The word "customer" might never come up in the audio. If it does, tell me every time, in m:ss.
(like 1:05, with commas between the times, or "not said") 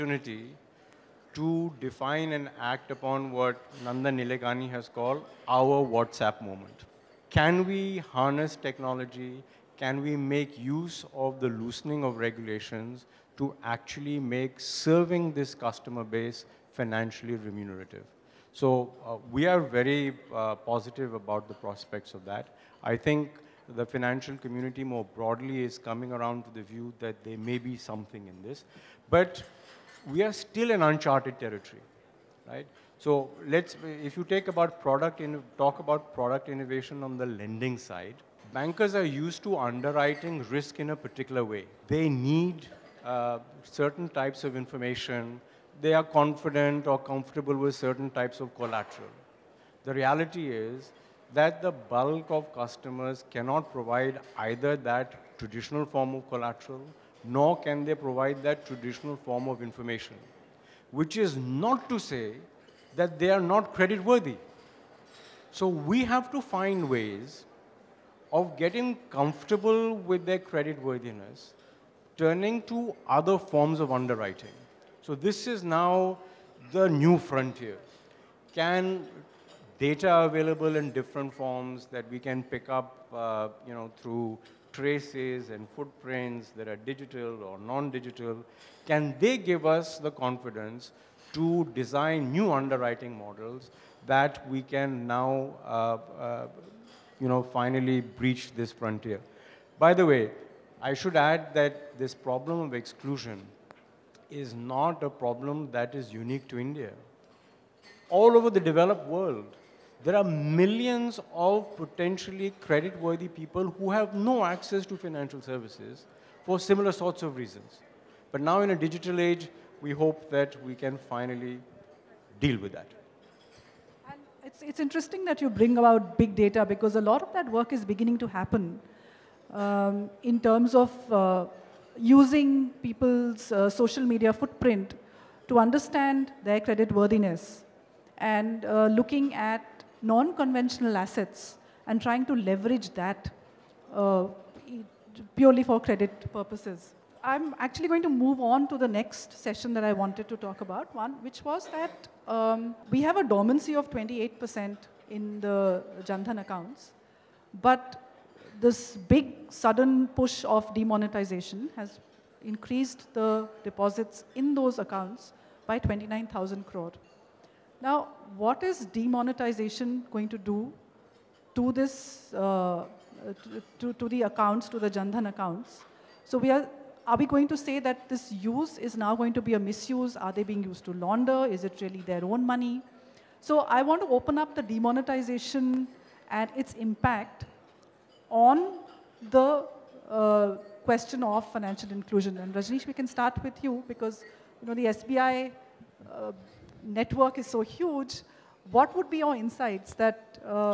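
0:15, 0:52.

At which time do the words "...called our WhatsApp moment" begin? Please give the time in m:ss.
0:04.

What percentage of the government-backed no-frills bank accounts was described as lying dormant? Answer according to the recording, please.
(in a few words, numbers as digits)
28%.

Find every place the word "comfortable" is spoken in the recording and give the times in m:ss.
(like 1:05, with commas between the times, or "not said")
0:46, 1:09.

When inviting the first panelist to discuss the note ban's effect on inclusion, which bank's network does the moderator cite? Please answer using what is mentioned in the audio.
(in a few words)
SBI.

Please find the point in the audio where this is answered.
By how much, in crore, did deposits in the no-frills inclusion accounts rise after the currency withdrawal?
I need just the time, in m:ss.
2:45.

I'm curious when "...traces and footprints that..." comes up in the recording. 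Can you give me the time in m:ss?
1:24.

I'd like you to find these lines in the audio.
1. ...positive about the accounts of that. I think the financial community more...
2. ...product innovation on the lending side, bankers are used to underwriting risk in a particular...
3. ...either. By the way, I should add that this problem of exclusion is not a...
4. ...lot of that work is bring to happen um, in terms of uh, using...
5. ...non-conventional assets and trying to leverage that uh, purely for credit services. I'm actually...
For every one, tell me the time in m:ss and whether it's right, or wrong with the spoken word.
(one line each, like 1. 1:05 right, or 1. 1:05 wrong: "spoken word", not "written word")
1. 0:20 wrong: "prospects", not "accounts"
2. 0:36 right
3. 1:38 wrong: "frontier", not "either"
4. 2:06 wrong: "beginning", not "bring"
5. 2:20 wrong: "purposes", not "services".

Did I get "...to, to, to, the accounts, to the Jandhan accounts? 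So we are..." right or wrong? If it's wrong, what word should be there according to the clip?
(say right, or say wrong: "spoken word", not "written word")
right.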